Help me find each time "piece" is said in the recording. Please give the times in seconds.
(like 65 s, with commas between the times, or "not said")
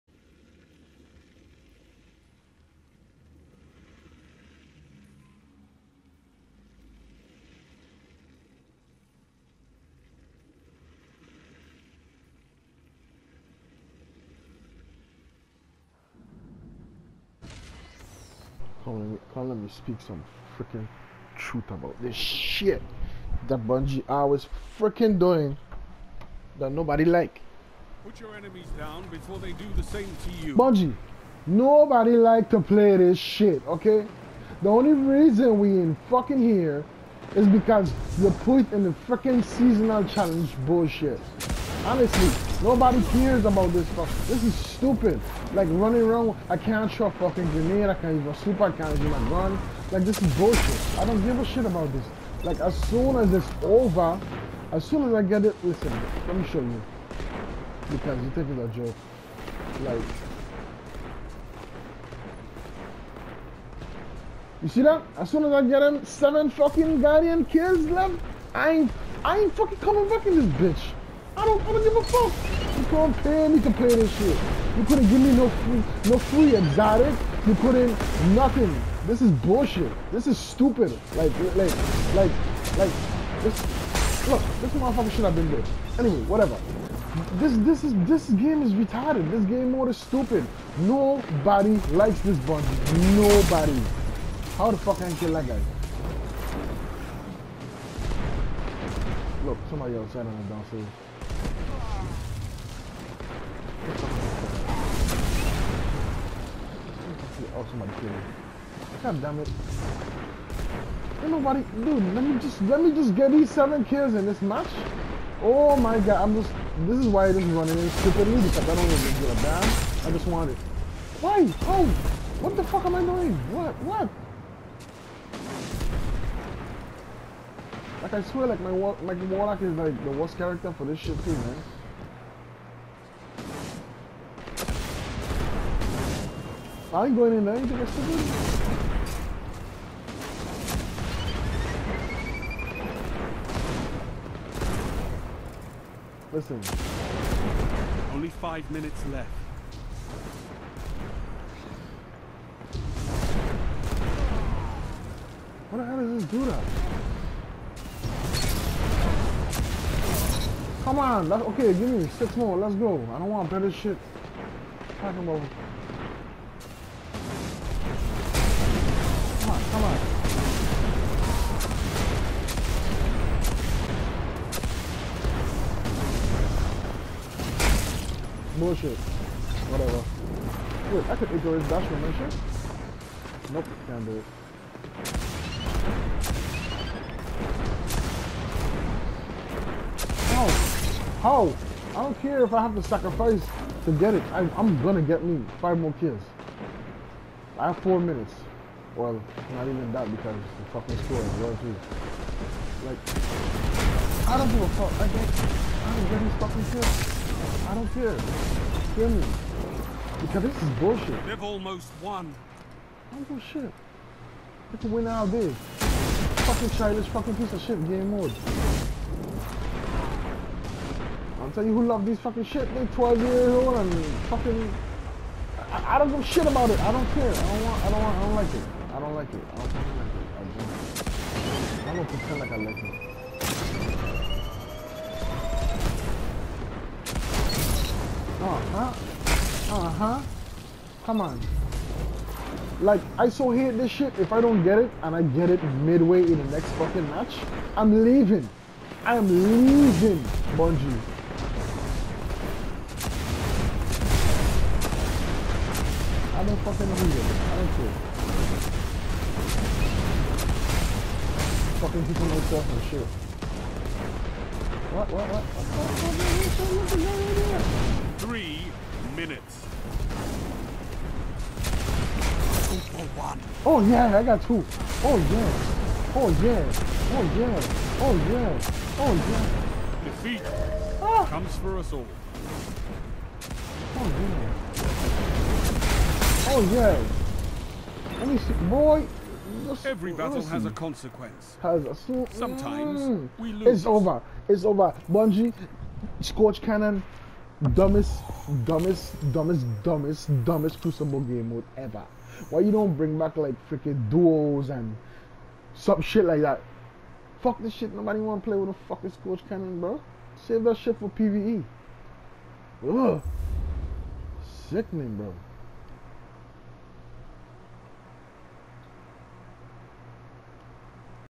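217 s.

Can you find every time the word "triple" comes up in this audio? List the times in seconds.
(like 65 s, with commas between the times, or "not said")
not said.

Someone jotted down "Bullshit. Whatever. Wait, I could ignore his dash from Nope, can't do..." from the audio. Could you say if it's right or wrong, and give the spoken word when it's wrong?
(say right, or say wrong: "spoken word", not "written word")
right.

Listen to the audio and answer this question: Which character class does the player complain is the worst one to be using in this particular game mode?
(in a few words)
Warlock.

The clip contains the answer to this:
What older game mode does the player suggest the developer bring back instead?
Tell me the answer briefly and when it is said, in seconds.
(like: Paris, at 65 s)
duos, at 304 s.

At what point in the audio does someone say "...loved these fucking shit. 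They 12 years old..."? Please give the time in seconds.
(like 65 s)
221 s.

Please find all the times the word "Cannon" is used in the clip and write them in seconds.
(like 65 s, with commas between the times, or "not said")
296 s, 309 s.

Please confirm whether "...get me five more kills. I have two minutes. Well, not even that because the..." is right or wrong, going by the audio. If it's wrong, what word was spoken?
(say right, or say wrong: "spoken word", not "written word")
wrong: "four", not "two".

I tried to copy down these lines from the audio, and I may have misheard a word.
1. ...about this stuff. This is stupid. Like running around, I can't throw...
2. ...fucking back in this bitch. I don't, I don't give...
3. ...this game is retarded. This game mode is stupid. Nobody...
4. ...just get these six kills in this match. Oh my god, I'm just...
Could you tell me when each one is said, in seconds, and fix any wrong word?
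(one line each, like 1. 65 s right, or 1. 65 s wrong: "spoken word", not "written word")
1. 43 s right
2. 69 s wrong: "coming", not "fucking"
3. 88 s right
4. 112 s wrong: "seven", not "six".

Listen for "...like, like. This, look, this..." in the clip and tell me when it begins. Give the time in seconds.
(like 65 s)
82 s.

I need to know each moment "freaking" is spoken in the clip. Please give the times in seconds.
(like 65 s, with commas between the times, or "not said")
20 s, 24 s, 39 s, 303 s.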